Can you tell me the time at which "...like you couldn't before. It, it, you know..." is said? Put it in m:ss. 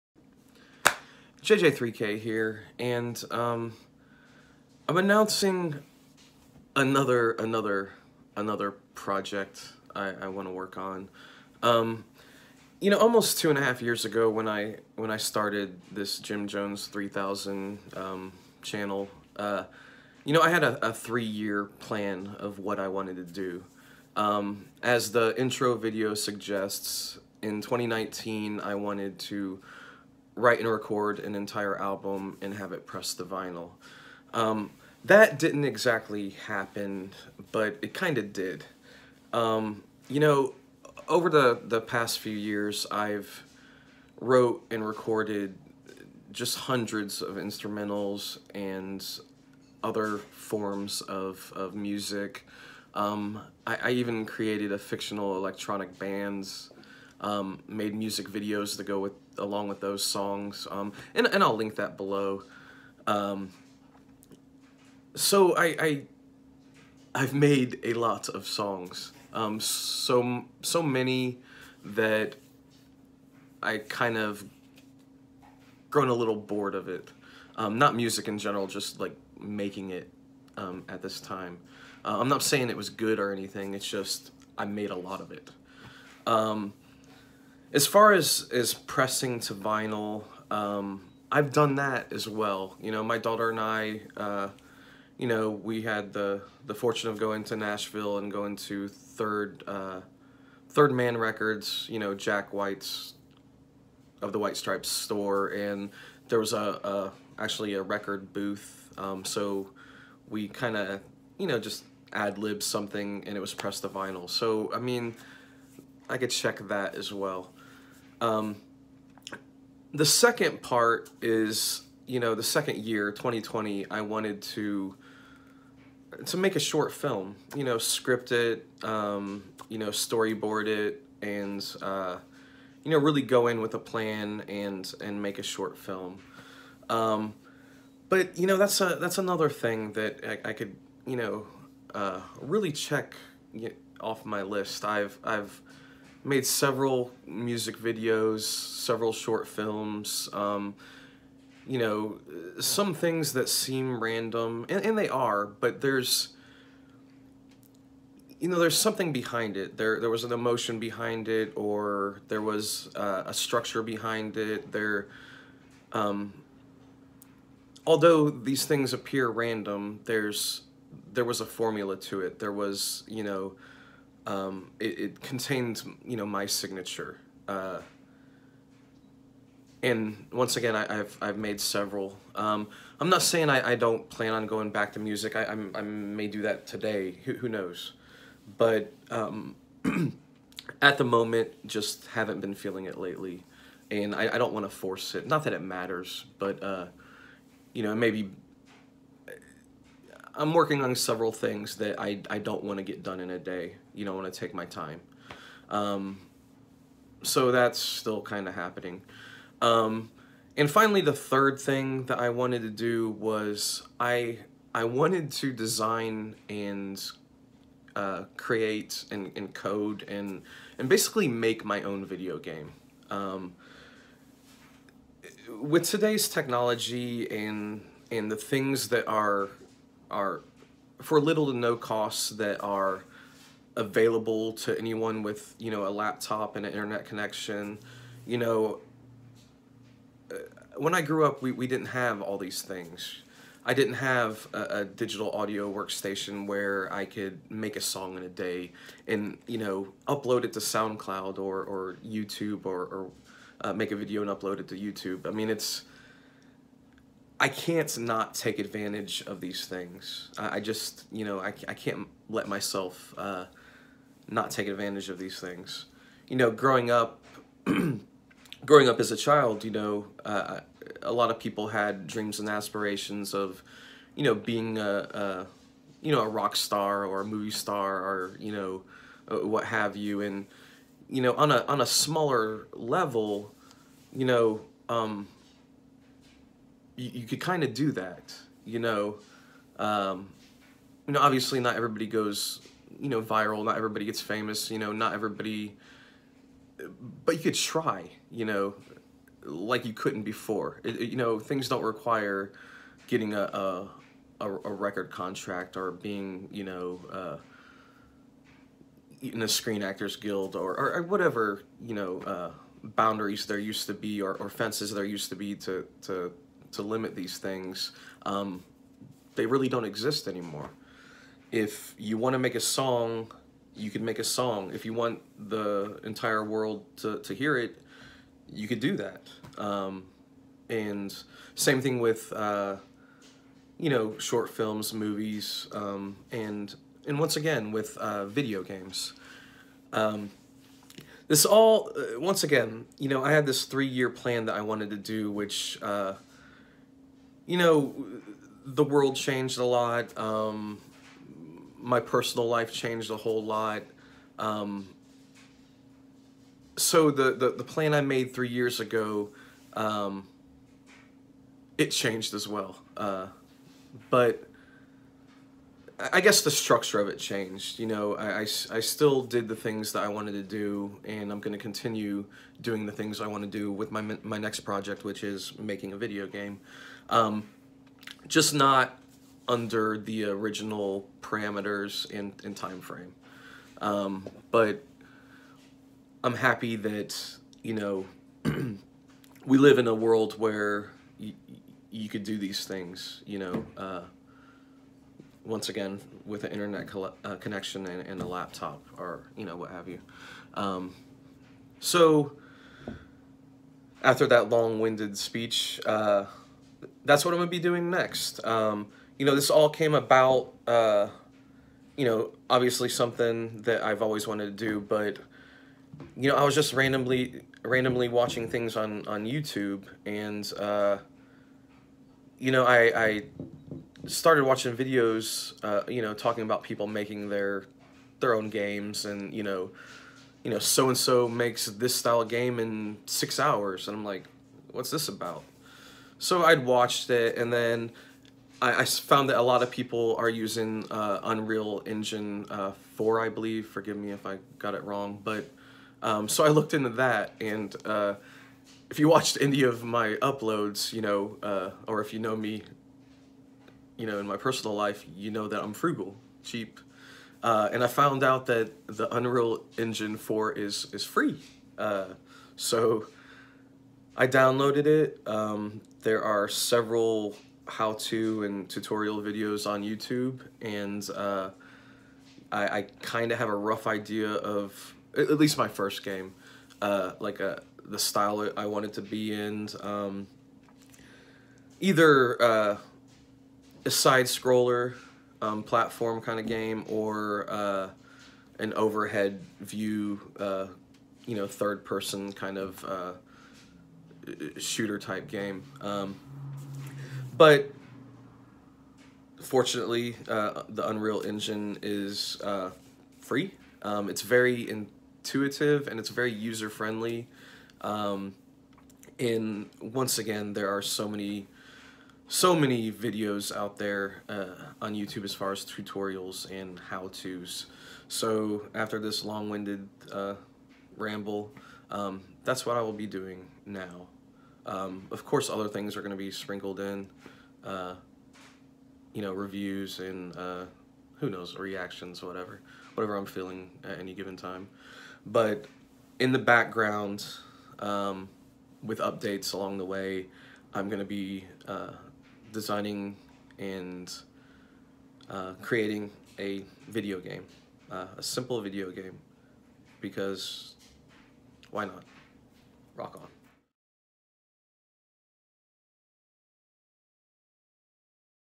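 4:59.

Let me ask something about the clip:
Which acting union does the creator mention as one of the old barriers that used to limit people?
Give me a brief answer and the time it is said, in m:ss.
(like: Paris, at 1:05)
Screen Actors Guild, at 5:09.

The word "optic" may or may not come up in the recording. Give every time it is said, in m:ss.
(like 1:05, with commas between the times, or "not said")
not said.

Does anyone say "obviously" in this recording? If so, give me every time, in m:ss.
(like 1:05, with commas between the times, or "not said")
4:51, 6:52.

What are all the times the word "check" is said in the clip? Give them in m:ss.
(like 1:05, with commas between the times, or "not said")
1:56, 2:22.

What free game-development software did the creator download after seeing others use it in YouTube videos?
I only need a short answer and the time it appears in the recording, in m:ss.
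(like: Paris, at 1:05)
Unreal Engine 4, at 7:21.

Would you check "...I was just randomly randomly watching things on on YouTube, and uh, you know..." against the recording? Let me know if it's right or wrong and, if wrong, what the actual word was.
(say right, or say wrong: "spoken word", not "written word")
right.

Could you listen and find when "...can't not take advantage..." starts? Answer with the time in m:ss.
4:17.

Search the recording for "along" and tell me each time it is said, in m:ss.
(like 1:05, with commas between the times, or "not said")
0:59, 8:59.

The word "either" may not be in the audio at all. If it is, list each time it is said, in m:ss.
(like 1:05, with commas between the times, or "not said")
8:01.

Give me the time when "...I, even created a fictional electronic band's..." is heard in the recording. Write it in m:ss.
0:53.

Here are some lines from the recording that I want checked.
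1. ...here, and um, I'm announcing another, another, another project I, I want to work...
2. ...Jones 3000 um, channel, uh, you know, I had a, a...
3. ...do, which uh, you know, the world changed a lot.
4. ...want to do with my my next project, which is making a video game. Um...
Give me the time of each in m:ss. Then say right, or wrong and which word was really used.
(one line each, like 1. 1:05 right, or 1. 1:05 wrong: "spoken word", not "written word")
1. 0:02 right
2. 0:16 right
3. 5:44 right
4. 6:13 right.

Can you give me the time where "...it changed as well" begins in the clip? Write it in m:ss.
6:01.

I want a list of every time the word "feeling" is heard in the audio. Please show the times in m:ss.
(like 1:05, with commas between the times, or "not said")
3:12, 8:53.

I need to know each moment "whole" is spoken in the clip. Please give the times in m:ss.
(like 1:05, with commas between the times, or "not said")
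5:53.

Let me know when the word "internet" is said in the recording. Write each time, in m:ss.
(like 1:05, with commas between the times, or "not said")
3:56, 6:36.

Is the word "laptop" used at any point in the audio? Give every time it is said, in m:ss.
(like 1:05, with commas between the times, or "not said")
3:55, 6:38.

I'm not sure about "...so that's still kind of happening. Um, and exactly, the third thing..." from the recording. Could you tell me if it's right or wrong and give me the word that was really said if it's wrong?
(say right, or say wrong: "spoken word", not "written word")
wrong: "finally", not "exactly".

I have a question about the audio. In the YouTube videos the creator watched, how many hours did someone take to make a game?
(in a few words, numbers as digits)
6.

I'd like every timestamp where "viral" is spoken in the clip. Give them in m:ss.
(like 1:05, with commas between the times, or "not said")
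4:53.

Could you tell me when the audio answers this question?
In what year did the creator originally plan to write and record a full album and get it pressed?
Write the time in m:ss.
0:27.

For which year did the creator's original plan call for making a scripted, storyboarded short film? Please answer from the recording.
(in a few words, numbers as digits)
2020.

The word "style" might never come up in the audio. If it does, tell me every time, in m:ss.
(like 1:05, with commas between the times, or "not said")
7:11, 7:57.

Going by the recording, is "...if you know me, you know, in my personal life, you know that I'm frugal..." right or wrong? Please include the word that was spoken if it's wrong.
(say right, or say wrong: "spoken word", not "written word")
right.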